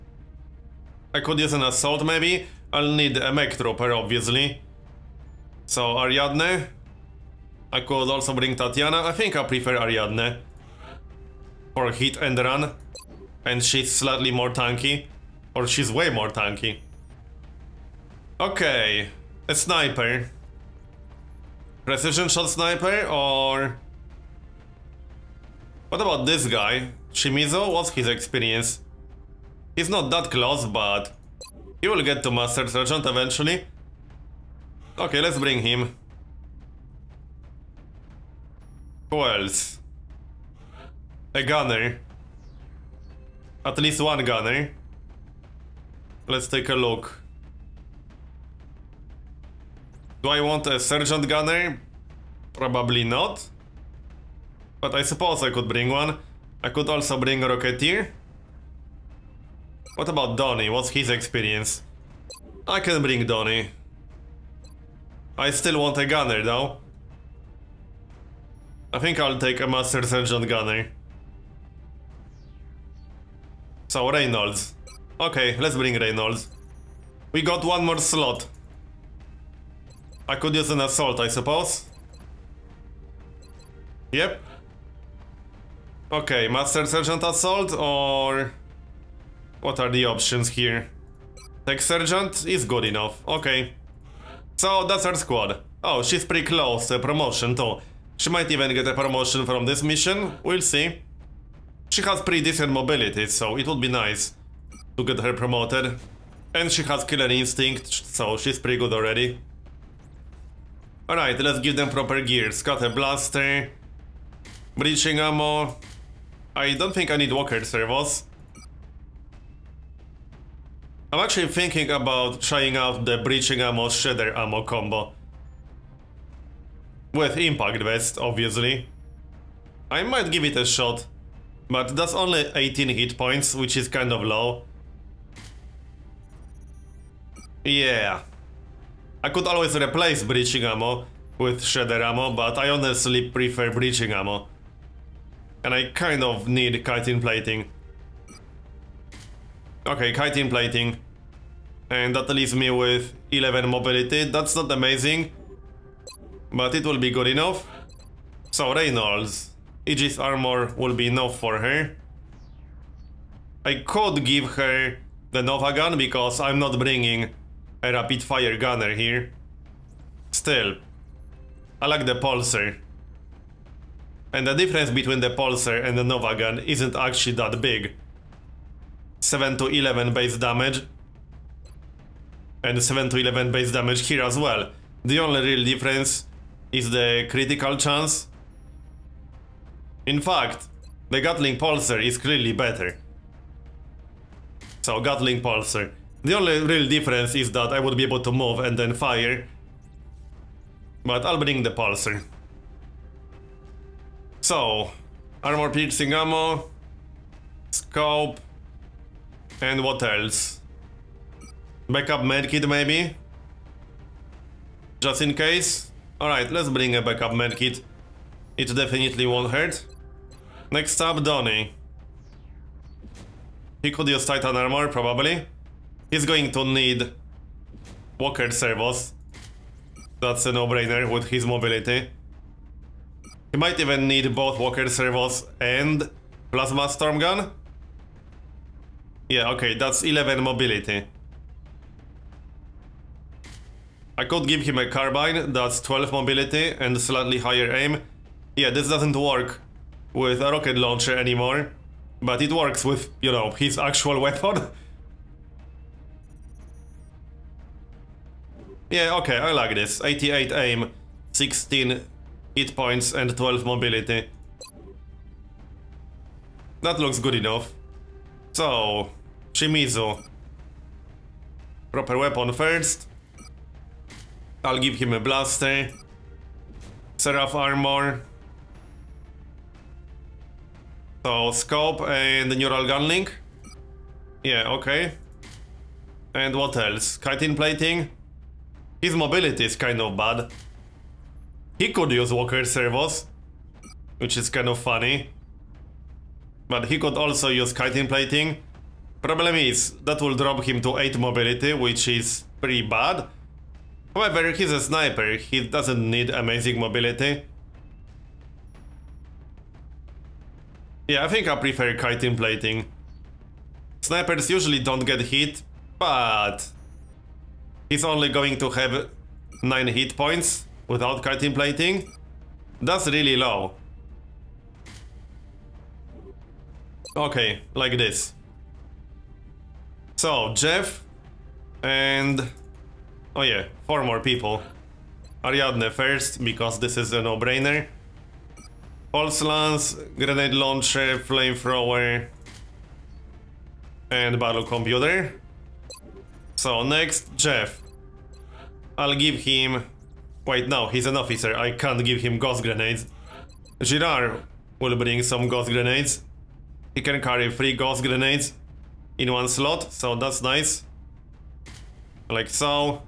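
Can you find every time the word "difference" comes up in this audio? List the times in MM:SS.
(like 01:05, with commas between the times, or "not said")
02:54, 03:05, 03:16.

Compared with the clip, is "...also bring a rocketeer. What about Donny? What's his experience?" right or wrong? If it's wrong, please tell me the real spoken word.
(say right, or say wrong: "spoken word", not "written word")
right.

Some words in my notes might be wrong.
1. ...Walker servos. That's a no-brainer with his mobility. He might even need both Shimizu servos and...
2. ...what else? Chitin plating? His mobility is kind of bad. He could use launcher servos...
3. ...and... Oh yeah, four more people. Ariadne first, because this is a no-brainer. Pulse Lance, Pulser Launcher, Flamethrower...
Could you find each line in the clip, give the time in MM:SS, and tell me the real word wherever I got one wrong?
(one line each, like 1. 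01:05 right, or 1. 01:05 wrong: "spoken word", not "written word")
1. 03:48 wrong: "Walker", not "Shimizu"
2. 04:46 wrong: "walker", not "launcher"
3. 05:31 wrong: "Grenade", not "Pulser".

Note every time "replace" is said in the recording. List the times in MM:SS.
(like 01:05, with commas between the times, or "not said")
02:19.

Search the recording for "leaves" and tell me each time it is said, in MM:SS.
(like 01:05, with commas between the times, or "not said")
02:32.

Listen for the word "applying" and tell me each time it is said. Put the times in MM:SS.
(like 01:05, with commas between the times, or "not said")
not said.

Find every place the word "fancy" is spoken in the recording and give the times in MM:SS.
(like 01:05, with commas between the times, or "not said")
not said.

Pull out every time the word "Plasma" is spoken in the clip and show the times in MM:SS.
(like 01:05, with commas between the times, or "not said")
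03:56.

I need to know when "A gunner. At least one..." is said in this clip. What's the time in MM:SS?
00:41.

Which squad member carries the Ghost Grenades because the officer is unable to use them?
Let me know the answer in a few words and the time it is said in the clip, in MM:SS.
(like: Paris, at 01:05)
Girard, at 05:53.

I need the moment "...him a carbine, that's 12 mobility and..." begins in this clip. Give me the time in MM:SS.
04:04.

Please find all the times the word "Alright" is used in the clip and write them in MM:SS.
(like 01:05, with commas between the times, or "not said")
01:51, 03:36.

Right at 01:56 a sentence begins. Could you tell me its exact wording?
I don't think I need walker servos.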